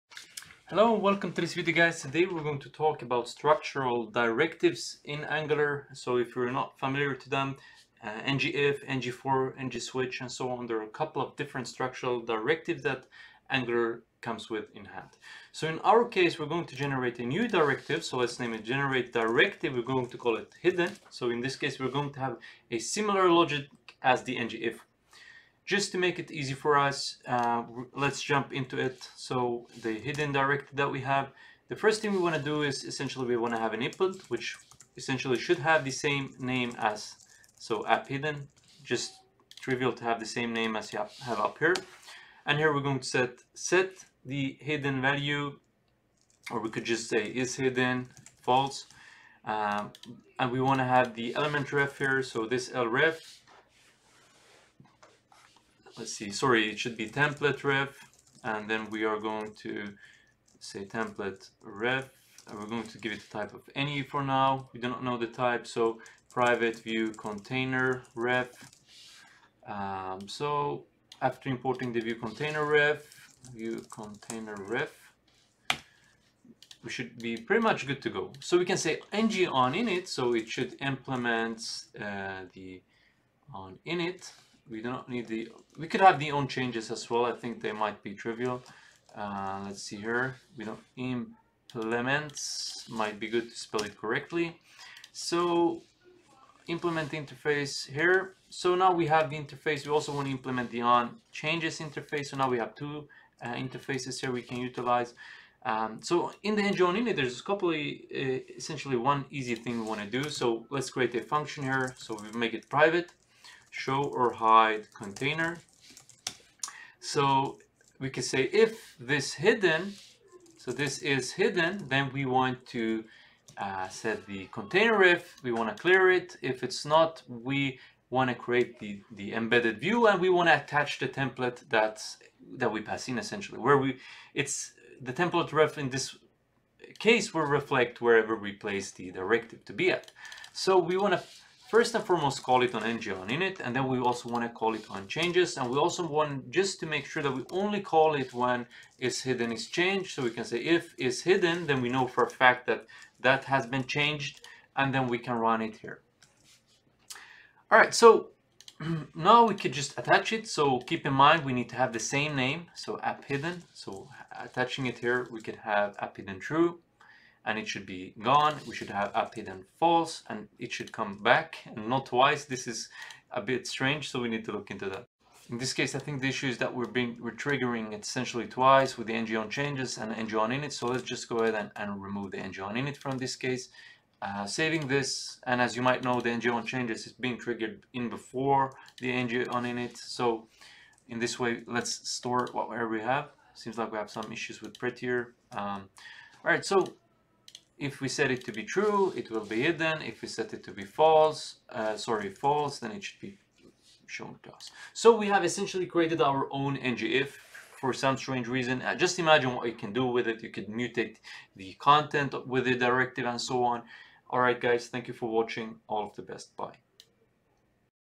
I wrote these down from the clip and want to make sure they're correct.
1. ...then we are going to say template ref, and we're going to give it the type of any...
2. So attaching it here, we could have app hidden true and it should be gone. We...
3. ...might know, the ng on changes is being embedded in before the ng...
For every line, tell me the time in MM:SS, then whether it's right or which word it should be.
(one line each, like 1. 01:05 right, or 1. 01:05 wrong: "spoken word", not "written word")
1. 00:58 right
2. 02:43 right
3. 03:05 wrong: "triggered", not "embedded".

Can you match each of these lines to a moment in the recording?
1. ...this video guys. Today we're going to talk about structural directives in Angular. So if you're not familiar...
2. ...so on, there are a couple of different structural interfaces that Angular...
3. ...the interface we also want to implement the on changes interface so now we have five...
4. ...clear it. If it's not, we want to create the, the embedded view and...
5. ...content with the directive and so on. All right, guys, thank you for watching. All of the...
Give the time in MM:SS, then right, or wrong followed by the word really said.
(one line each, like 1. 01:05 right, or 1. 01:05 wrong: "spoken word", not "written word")
1. 00:01 right
2. 00:10 wrong: "directives", not "interfaces"
3. 01:39 wrong: "two", not "five"
4. 02:05 right
5. 03:31 right.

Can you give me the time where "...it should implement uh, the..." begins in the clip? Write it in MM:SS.
01:20.